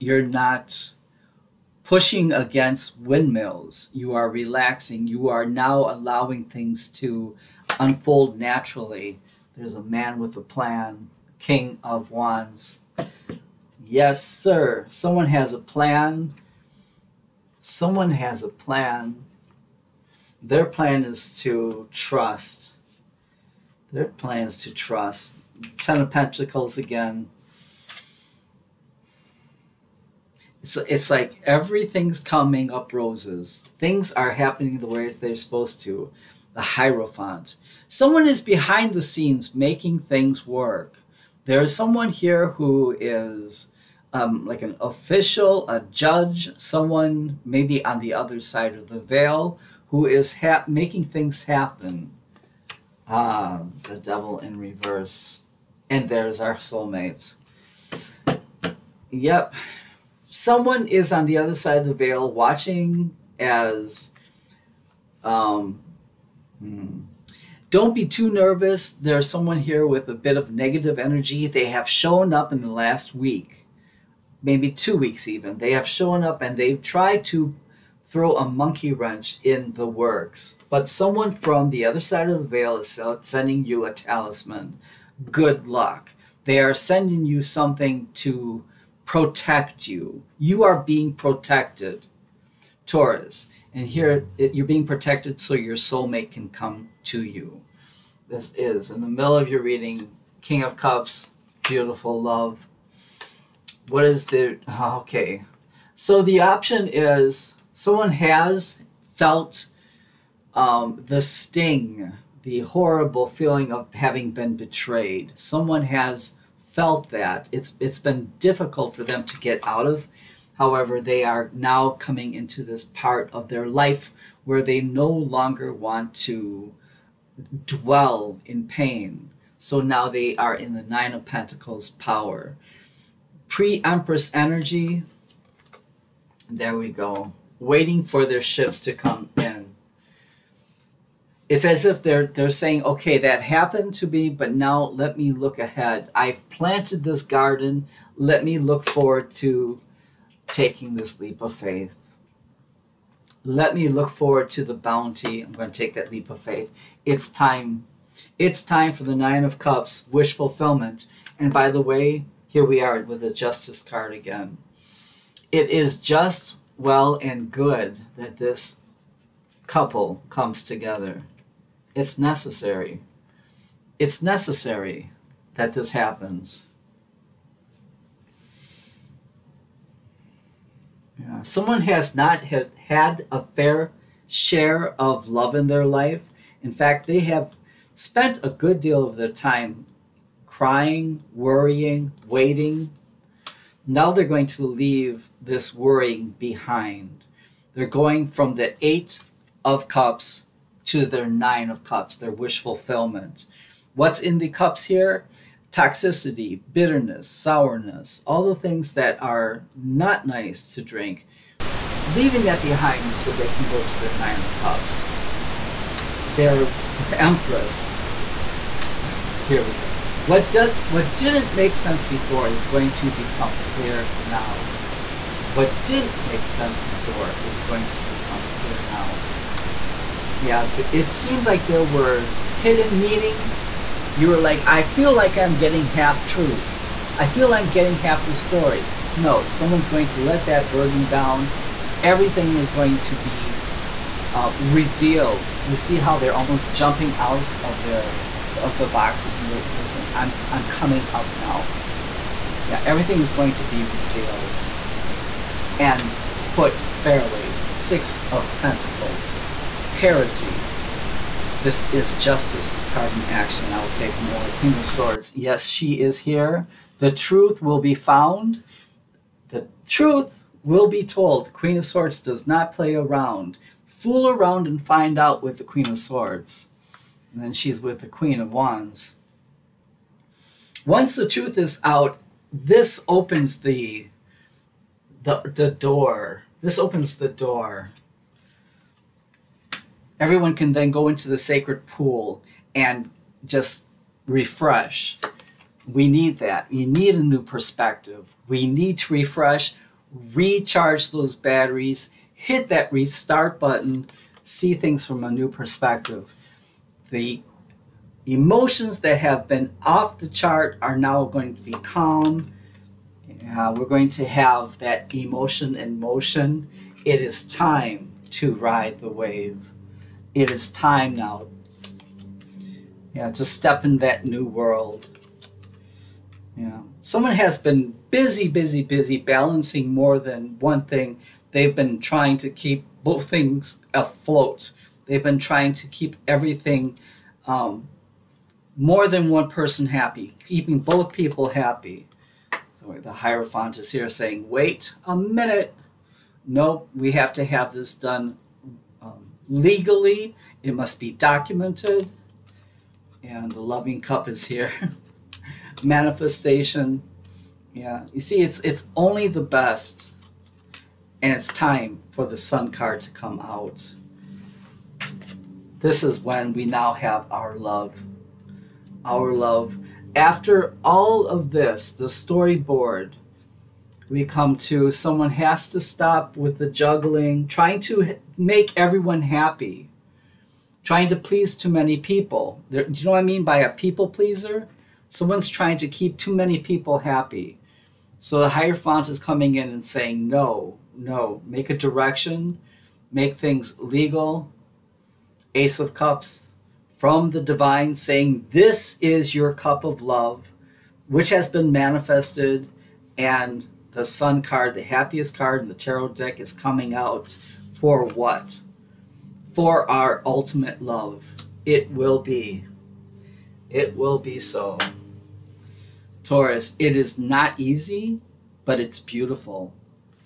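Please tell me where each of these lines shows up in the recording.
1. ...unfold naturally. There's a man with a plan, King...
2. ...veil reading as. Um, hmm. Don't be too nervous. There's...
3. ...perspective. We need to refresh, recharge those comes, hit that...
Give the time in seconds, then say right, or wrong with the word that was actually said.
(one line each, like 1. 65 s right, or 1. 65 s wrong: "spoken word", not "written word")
1. 7 s right
2. 61 s wrong: "watching", not "reading"
3. 297 s wrong: "batteries", not "comes".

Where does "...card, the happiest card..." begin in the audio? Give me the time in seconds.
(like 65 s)
404 s.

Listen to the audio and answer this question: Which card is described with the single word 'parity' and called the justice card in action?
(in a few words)
Six of Pentacles.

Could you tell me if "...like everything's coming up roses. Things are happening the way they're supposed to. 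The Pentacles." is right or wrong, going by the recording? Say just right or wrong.
wrong.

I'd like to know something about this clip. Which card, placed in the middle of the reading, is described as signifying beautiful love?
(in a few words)
King of Cups.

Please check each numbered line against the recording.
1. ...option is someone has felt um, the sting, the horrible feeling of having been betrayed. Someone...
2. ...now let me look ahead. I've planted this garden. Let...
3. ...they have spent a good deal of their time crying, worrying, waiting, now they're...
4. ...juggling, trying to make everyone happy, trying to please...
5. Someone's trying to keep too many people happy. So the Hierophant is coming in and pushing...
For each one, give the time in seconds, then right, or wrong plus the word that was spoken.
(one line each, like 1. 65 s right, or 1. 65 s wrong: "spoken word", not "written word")
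1. 106 s right
2. 144 s right
3. 187 s right
4. 376 s right
5. 385 s wrong: "saying", not "pushing".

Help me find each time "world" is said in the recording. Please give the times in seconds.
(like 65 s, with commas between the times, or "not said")
324 s.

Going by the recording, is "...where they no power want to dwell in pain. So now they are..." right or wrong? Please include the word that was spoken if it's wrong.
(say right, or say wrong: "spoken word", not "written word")
wrong: "longer", not "power".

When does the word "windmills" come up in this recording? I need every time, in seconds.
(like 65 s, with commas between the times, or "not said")
3 s.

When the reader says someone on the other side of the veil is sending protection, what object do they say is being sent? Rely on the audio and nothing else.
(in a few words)
A talisman.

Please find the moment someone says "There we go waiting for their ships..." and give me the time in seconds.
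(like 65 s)
136 s.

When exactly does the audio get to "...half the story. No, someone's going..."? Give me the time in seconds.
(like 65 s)
237 s.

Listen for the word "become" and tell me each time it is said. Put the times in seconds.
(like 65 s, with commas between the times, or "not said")
223 s, 228 s.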